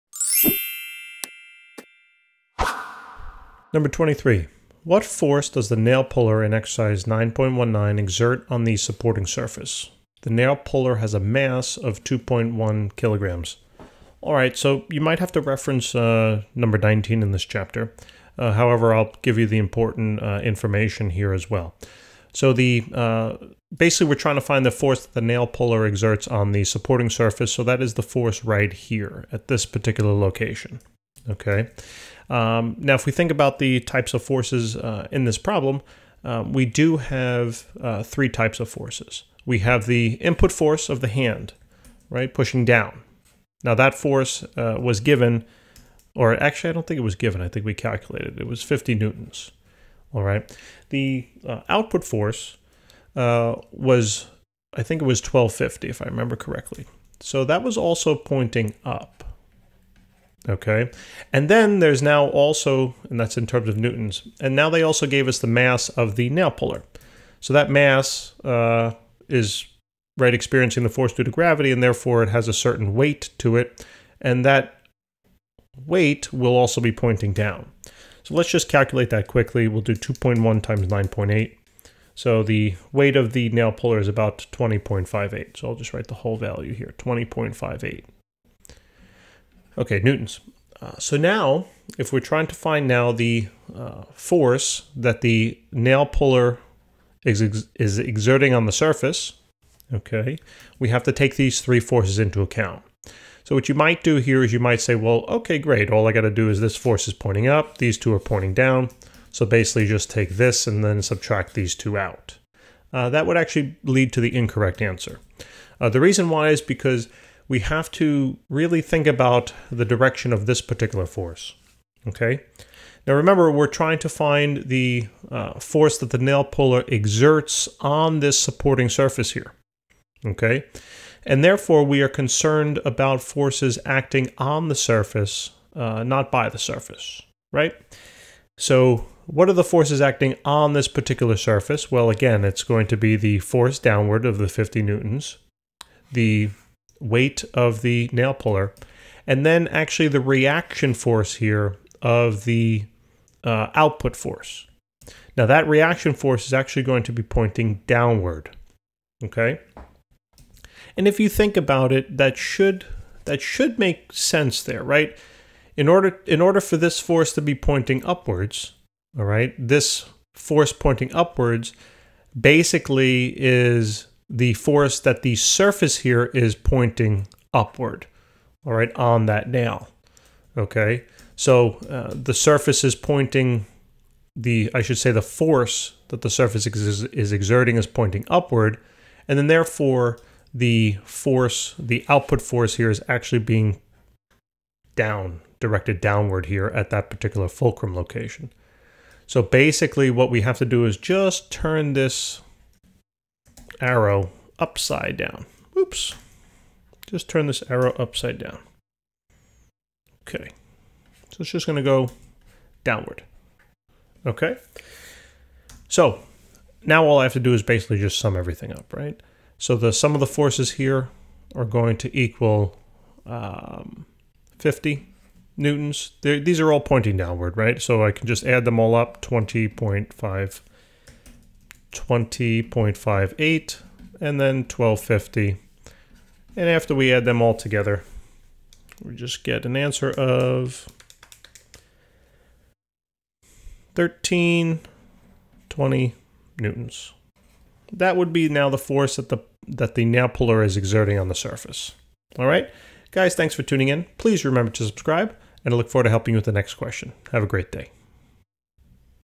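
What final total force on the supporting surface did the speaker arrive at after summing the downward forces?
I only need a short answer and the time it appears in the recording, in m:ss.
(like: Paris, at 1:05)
1320 newtons, at 4:03.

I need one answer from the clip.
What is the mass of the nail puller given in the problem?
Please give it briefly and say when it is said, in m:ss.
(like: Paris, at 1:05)
2.1 kg, at 0:12.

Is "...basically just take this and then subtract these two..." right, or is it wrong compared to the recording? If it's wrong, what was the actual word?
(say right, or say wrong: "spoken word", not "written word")
right.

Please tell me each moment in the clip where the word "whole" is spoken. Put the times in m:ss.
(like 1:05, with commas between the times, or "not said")
1:26.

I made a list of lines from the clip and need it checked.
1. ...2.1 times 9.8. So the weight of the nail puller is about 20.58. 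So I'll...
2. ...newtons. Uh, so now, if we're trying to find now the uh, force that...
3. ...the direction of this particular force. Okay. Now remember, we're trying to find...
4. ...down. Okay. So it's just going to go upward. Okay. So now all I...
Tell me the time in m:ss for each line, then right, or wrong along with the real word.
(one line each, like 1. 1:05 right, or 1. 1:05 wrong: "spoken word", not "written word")
1. 1:19 right
2. 1:29 right
3. 1:59 right
4. 3:28 wrong: "downward", not "upward".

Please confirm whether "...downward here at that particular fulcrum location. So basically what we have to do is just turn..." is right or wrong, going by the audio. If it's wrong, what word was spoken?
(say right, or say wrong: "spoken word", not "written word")
right.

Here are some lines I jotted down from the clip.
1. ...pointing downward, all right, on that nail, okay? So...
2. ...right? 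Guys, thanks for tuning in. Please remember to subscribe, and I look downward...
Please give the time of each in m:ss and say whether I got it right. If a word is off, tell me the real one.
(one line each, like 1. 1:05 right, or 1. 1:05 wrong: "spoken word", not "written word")
1. 2:56 wrong: "upward", not "downward"
2. 4:12 wrong: "forward", not "downward".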